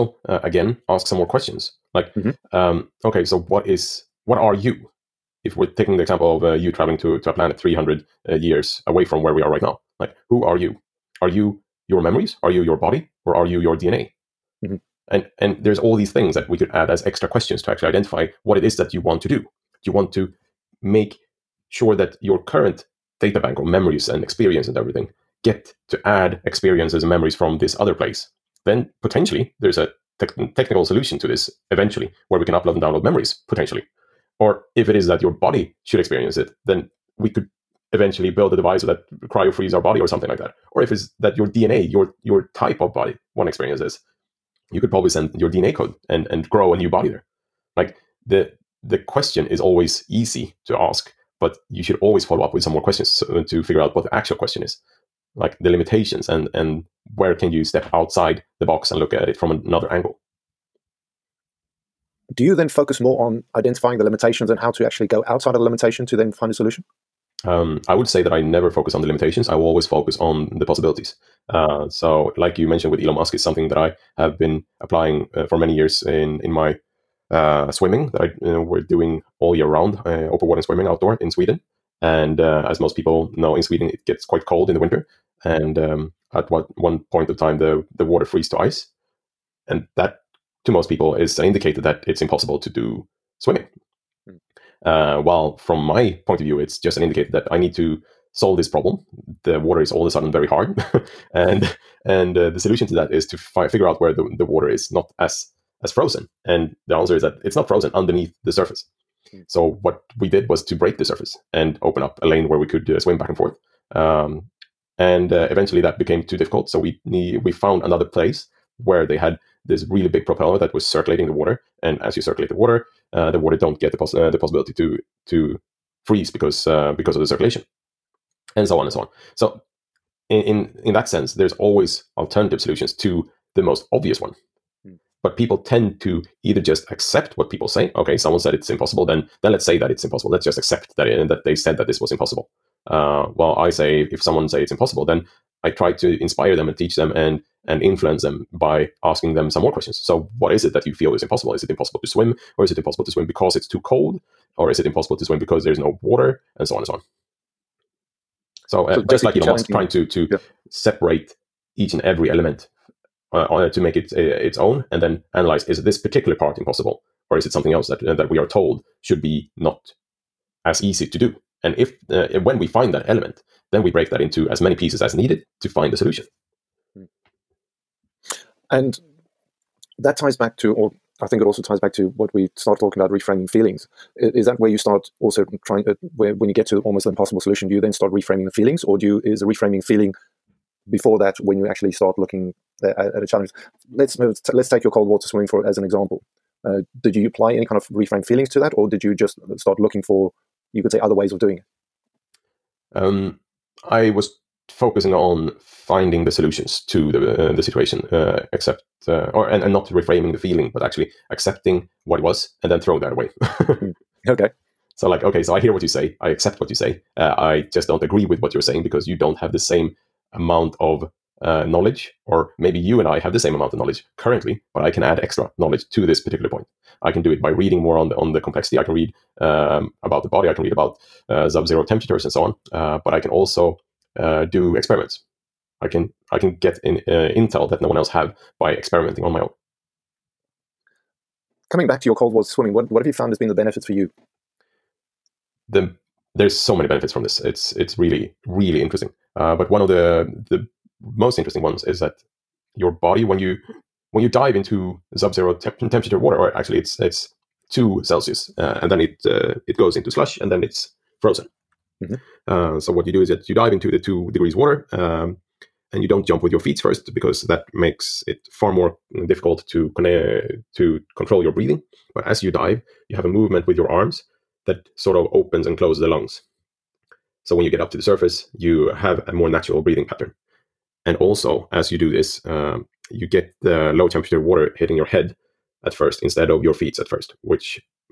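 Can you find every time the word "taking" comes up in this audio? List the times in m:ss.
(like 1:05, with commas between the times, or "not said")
0:05.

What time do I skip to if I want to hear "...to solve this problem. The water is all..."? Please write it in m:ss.
1:37.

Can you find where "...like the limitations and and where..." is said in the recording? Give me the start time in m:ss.
0:55.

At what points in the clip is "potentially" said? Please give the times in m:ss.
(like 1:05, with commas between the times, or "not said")
0:29, 0:33.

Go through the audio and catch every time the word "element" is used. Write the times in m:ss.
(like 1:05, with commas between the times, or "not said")
2:42, 2:53.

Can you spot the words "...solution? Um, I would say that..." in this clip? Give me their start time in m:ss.
1:06.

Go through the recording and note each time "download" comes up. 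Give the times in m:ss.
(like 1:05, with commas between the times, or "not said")
0:32.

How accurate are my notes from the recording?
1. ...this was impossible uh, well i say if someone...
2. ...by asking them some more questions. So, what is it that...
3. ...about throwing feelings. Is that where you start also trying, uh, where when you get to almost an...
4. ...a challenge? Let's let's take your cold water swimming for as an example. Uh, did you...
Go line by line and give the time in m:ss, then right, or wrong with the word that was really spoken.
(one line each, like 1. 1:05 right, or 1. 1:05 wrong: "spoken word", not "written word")
1. 2:21 right
2. 2:28 right
3. 3:02 wrong: "reframing", not "throwing"
4. 3:13 right.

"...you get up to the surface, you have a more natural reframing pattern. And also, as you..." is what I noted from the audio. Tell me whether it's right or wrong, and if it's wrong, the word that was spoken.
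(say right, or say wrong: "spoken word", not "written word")
wrong: "breathing", not "reframing".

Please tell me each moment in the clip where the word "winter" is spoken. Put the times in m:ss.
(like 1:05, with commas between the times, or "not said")
1:24.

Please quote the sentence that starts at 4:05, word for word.
The there's so many benefits from this.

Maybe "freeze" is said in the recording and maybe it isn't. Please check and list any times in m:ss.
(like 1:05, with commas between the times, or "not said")
0:39, 1:28, 2:06.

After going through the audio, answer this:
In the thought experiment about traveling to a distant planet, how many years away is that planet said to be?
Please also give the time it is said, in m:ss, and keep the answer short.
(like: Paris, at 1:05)
300, at 0:07.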